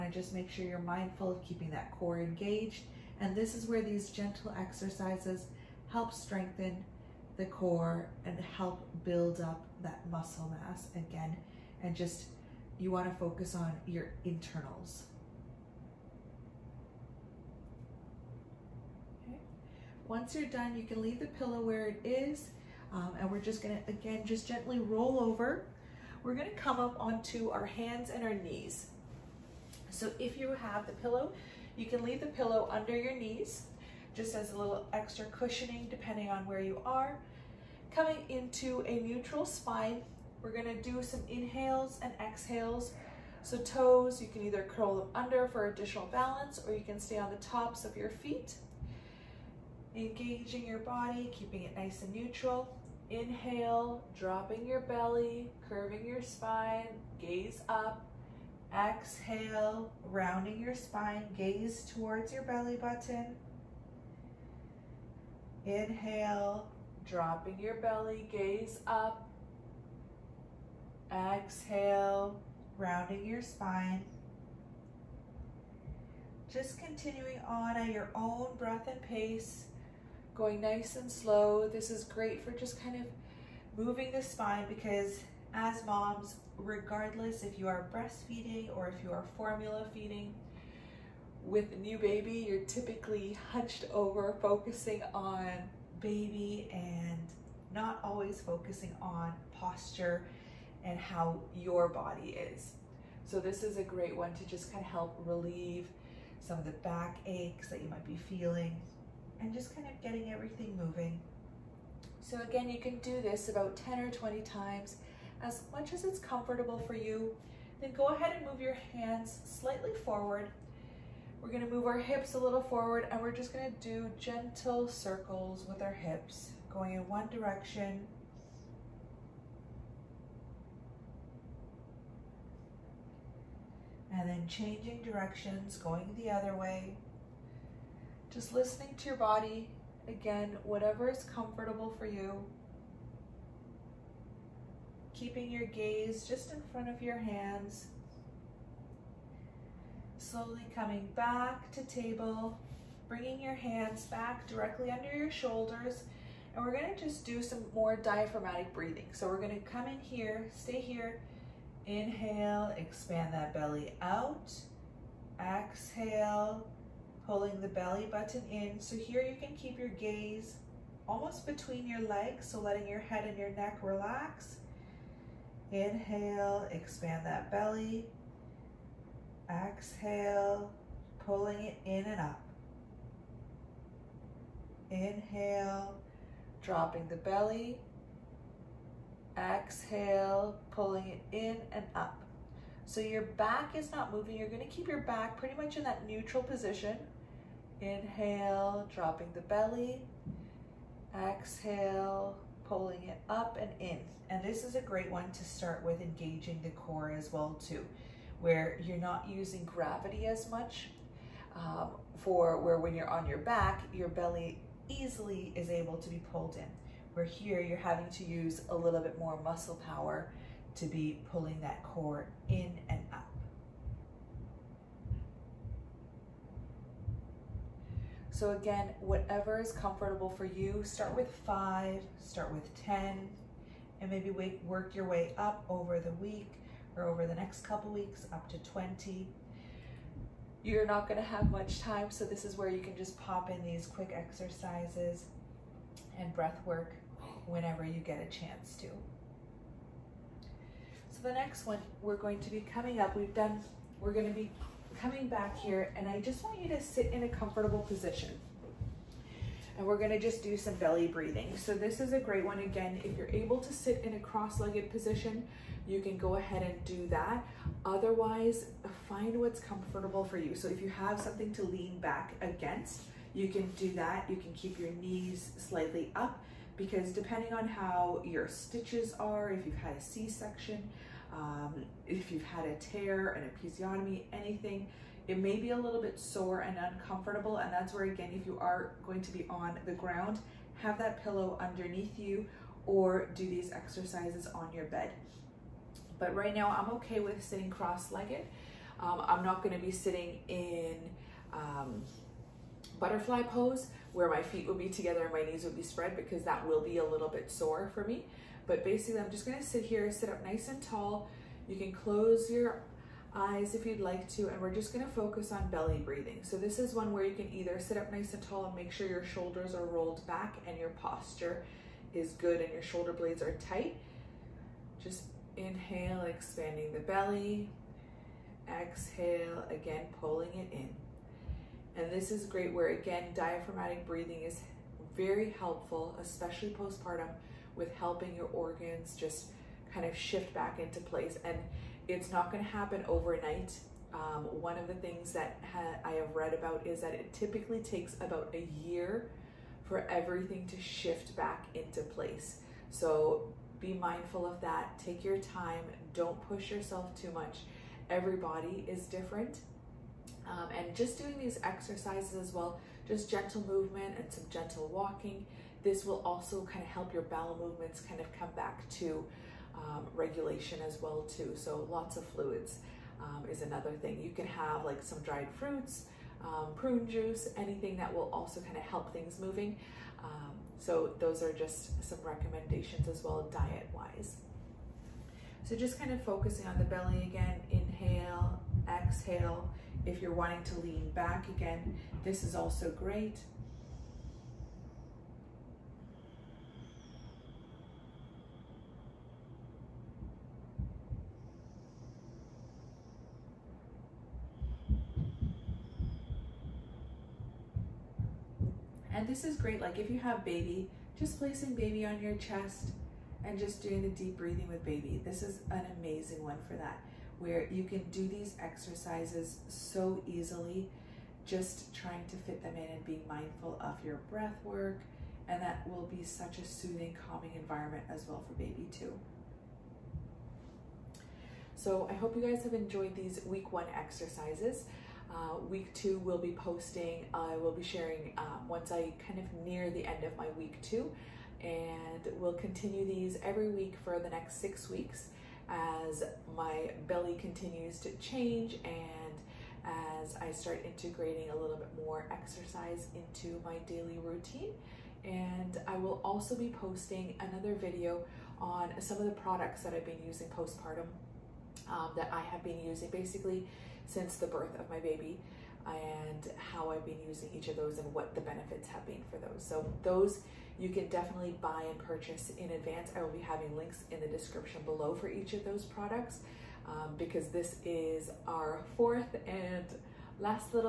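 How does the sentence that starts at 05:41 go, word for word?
And it's not going to happen overnight.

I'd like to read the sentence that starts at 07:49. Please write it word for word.
So those you can definitely buy and purchase in advance.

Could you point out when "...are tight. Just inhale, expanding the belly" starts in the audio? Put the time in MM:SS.
05:23.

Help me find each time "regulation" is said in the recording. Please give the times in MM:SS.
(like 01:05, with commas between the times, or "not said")
06:10.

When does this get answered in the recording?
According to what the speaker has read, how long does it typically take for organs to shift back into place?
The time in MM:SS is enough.
05:48.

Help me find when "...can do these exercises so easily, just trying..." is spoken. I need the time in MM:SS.
06:57.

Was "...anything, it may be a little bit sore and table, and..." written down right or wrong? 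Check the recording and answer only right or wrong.
wrong.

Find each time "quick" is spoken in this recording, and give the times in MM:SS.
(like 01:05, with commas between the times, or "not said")
04:03.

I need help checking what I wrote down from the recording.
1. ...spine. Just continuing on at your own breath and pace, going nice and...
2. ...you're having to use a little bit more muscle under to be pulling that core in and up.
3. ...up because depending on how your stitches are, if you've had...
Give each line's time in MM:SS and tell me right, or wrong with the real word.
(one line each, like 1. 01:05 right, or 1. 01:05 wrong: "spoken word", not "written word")
1. 01:13 right
2. 03:37 wrong: "power", not "under"
3. 04:36 right.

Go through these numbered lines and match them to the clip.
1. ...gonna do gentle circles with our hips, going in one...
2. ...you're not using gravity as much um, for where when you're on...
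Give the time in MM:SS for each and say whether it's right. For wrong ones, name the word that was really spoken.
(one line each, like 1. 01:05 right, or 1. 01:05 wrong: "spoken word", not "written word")
1. 02:03 right
2. 03:28 right.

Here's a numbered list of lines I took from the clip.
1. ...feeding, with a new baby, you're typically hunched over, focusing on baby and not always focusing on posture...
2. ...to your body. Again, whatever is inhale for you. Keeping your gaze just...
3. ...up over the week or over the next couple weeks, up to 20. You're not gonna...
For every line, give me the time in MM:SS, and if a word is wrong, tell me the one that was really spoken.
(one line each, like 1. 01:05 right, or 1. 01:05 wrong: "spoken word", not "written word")
1. 01:29 right
2. 02:18 wrong: "comfortable", not "inhale"
3. 03:55 right.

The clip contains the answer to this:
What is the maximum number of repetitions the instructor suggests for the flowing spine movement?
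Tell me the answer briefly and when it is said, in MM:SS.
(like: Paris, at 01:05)
20, at 01:53.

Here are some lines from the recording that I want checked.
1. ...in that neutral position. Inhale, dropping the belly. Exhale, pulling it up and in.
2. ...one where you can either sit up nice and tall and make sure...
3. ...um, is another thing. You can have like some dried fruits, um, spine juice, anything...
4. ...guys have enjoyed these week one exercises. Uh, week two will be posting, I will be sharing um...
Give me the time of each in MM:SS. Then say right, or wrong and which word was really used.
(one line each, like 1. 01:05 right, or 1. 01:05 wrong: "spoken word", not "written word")
1. 03:15 right
2. 05:16 right
3. 06:13 wrong: "prune", not "spine"
4. 07:12 right.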